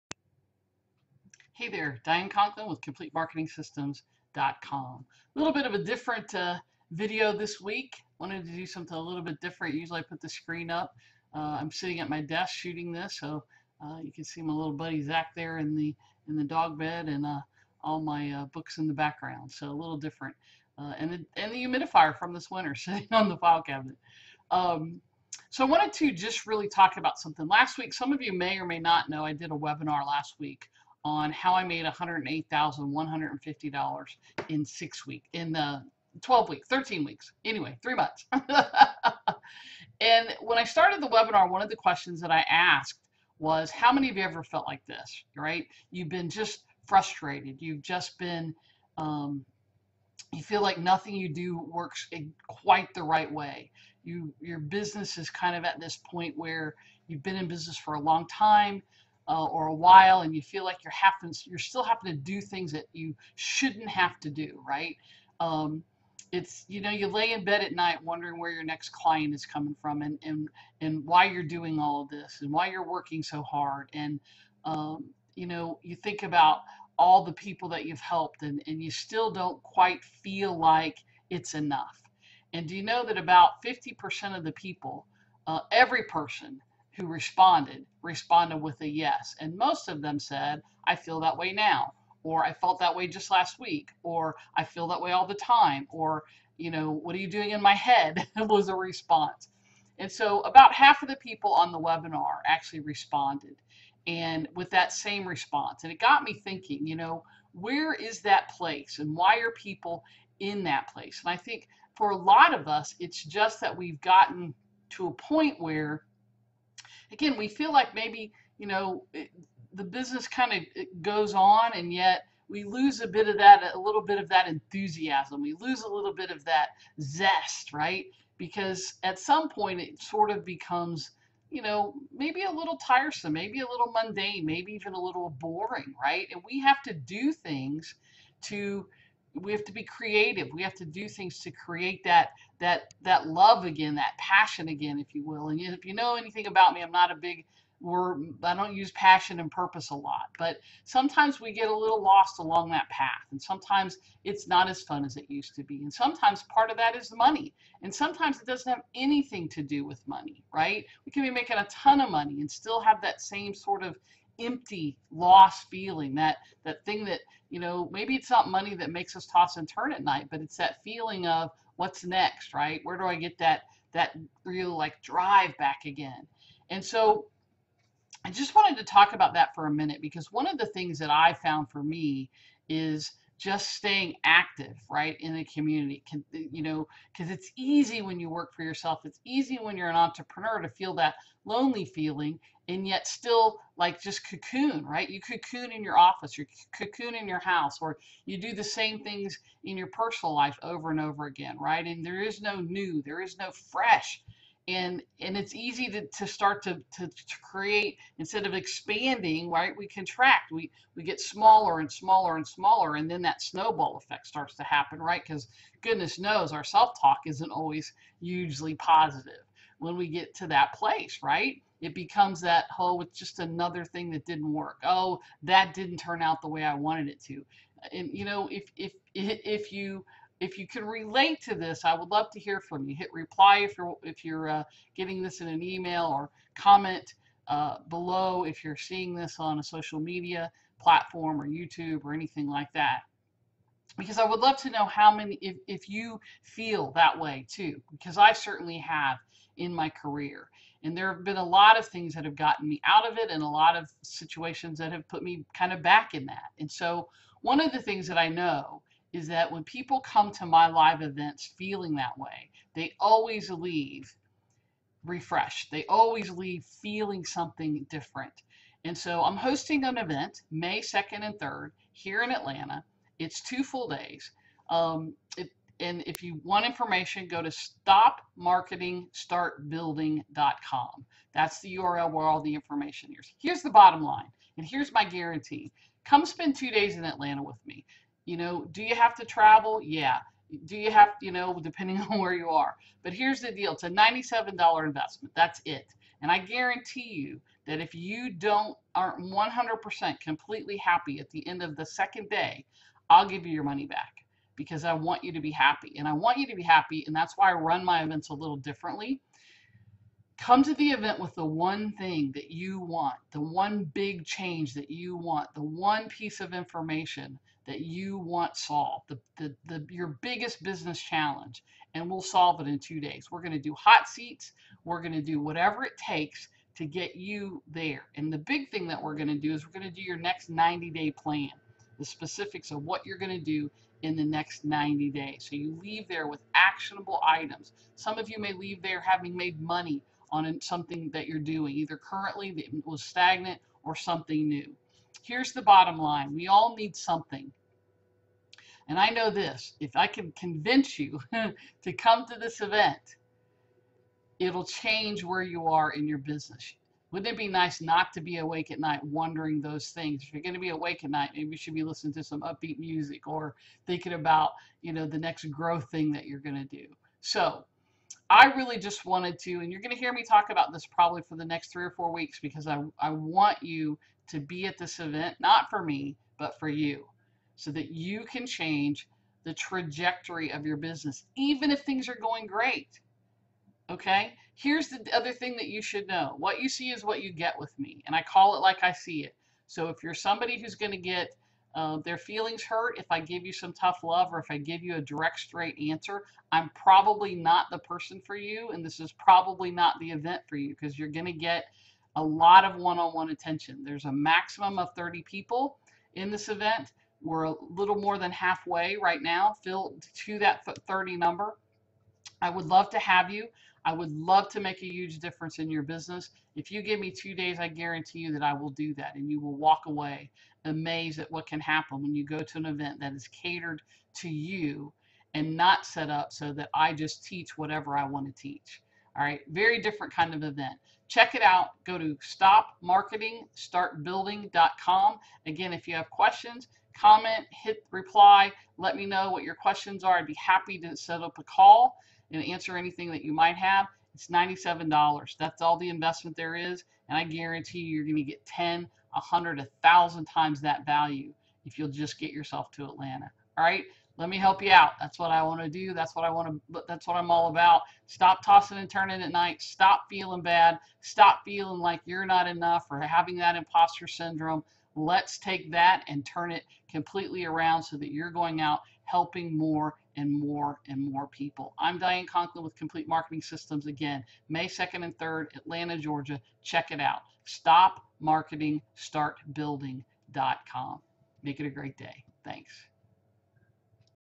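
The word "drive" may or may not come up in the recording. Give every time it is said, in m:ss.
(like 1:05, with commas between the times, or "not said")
2:55.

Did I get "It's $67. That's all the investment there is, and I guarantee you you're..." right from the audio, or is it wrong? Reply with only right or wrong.
wrong.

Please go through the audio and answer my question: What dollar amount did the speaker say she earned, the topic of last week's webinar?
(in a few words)
$108,150.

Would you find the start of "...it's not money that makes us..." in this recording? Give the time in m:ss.
2:48.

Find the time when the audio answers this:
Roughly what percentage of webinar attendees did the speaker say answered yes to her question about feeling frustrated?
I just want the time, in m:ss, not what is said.
1:23.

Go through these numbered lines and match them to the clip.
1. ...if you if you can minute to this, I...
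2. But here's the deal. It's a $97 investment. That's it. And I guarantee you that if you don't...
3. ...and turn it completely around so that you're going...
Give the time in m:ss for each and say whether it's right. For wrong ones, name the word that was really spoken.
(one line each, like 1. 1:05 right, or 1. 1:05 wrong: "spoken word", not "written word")
1. 3:49 wrong: "relate", not "minute"
2. 4:53 right
3. 7:46 right.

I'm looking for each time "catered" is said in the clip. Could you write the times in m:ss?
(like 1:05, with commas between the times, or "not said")
7:03.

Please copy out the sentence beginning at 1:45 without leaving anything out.
And it got me thinking, you know, where is that place and why are people in that place?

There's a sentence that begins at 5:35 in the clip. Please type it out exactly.
So you leave there with actionable items.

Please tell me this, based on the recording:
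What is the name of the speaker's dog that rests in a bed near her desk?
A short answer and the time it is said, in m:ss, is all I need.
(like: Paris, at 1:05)
Zach, at 0:15.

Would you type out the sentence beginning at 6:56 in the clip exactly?
If you give me two days, I guarantee you that I will do that.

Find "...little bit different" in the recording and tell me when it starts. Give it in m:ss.
0:08.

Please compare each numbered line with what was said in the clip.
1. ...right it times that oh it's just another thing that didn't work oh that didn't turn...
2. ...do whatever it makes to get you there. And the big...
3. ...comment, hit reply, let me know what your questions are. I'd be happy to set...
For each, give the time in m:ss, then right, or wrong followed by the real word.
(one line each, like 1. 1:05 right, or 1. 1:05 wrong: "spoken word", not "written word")
1. 3:41 wrong: "becomes", not "times"
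2. 5:25 wrong: "takes", not "makes"
3. 7:16 right.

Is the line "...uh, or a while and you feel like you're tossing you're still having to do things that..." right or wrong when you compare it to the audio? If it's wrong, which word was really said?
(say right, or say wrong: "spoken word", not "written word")
wrong: "having", not "tossing".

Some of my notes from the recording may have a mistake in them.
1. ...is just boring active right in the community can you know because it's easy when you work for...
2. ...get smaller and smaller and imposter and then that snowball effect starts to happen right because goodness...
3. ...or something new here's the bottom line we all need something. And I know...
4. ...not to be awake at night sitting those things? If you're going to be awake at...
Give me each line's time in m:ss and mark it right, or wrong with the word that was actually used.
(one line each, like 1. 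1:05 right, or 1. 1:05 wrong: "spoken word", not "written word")
1. 3:02 wrong: "staying", not "boring"
2. 3:31 wrong: "smaller", not "imposter"
3. 5:43 right
4. 5:57 wrong: "wondering", not "sitting".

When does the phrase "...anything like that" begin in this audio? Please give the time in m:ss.
4:02.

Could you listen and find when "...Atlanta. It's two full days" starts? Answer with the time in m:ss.
4:32.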